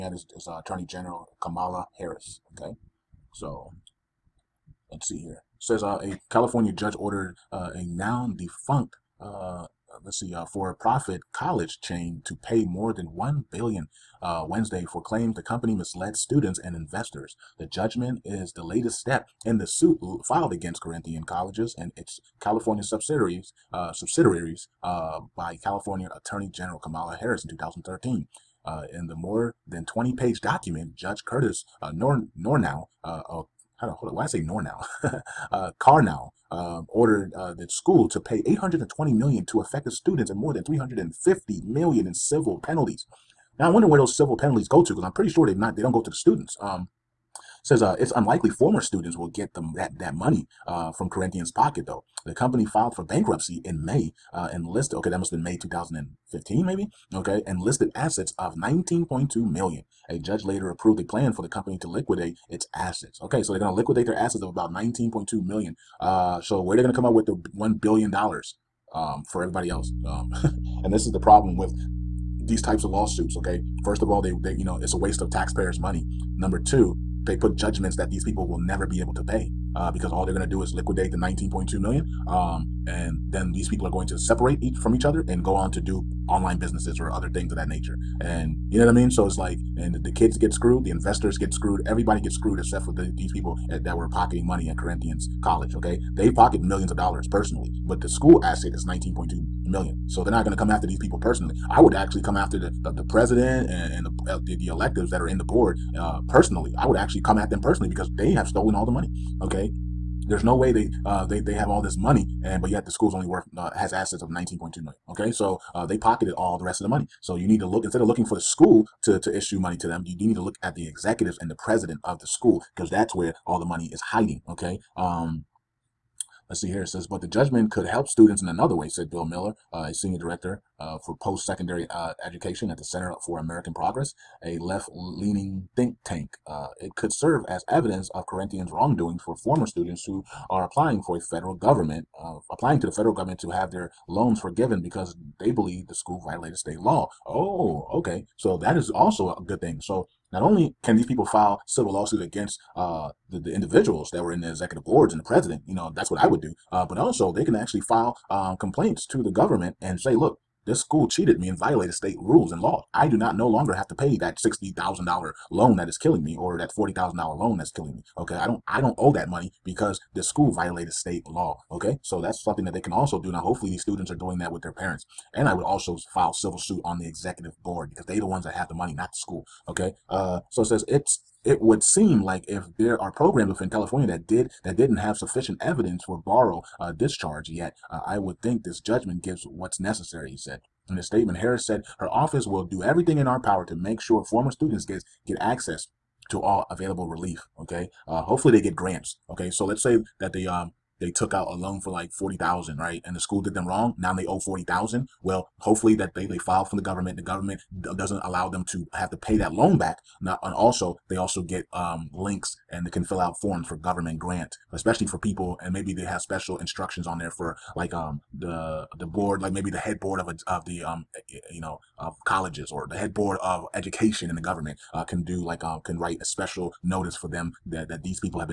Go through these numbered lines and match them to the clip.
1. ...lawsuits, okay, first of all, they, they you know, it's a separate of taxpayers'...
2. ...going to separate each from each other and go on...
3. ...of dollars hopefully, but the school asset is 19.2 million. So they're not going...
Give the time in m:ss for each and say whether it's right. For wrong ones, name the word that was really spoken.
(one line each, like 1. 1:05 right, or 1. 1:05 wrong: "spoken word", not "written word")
1. 1:12 wrong: "waste", not "separate"
2. 1:23 right
3. 1:36 wrong: "personally", not "hopefully".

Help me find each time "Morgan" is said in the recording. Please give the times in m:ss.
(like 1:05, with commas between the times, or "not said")
not said.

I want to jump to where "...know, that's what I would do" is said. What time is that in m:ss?
2:35.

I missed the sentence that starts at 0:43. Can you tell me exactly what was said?
Now I wonder where those civil penalties go to because I'm pretty sure they've not they don't go to the students.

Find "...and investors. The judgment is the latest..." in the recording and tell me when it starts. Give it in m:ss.
0:16.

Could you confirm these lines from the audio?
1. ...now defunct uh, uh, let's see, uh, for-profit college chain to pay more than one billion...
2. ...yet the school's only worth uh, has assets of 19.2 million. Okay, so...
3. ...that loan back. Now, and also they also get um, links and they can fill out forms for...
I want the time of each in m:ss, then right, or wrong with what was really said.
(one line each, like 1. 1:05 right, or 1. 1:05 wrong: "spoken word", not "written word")
1. 0:07 right
2. 1:52 right
3. 3:29 right.